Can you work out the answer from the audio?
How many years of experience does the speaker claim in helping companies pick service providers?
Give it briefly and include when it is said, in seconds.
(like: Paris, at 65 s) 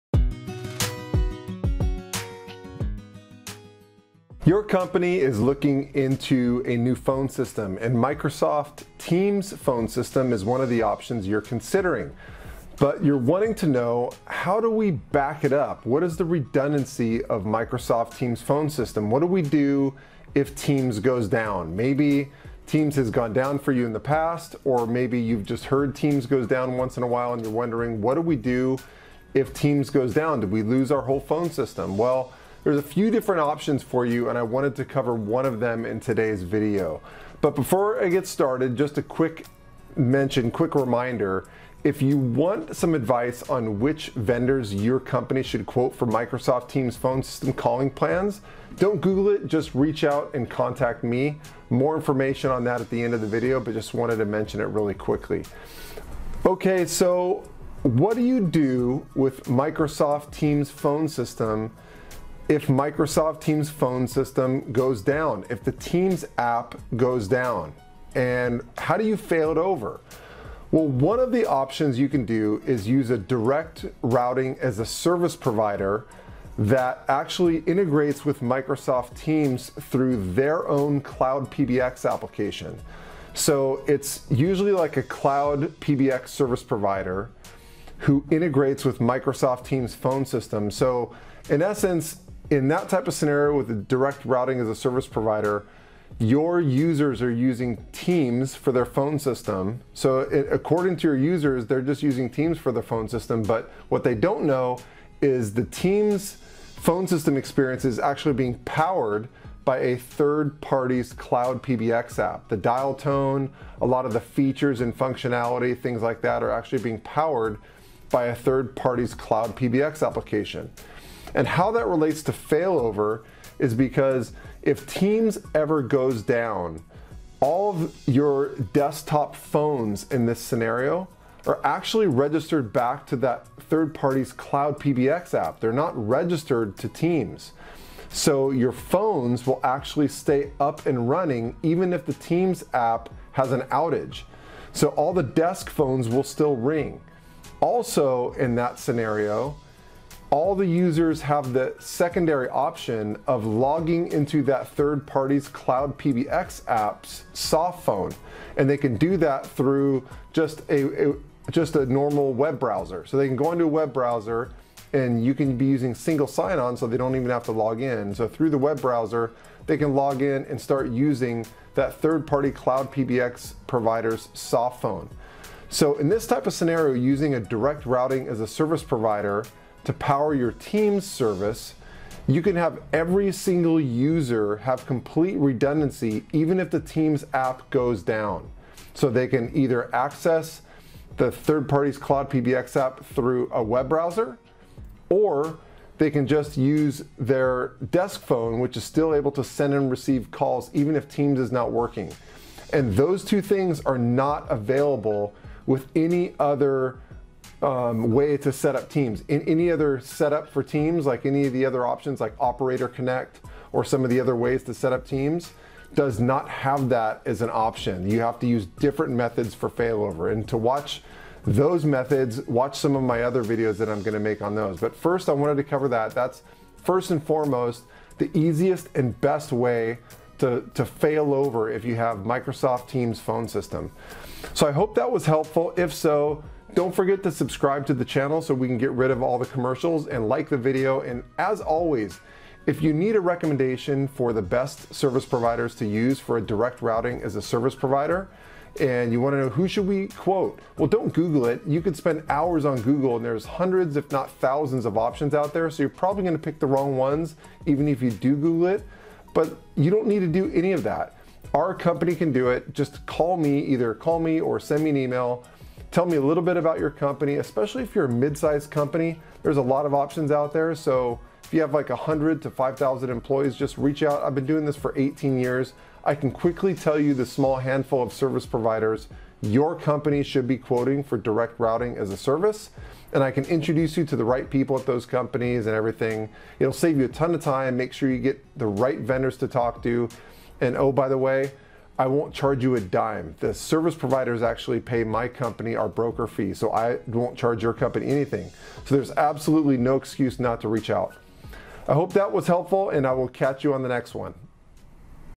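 18, at 274 s.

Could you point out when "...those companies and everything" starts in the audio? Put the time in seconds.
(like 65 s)
284 s.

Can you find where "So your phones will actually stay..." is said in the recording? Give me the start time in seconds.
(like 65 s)
138 s.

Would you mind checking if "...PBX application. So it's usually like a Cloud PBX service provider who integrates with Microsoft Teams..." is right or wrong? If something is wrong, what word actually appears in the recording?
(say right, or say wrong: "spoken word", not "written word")
right.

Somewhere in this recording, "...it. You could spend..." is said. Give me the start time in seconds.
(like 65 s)
251 s.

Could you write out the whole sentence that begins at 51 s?
More information on that at the end of the video, but just wanted to mention it really quickly.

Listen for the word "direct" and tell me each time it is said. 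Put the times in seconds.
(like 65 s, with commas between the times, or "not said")
73 s, 93 s, 177 s, 246 s, 281 s.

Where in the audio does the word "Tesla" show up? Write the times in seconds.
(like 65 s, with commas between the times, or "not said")
not said.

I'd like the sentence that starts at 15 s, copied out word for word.
What is the redundancy of Microsoft Teams phone system?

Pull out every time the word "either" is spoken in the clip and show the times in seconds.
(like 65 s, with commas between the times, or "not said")
189 s, 263 s.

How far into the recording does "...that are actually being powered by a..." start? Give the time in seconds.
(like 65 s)
116 s.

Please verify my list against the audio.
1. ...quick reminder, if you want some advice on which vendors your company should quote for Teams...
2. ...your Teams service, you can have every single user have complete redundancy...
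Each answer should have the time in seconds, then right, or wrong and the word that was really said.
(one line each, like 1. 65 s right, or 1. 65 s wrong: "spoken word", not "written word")
1. 40 s wrong: "Microsoft", not "Teams"
2. 180 s right.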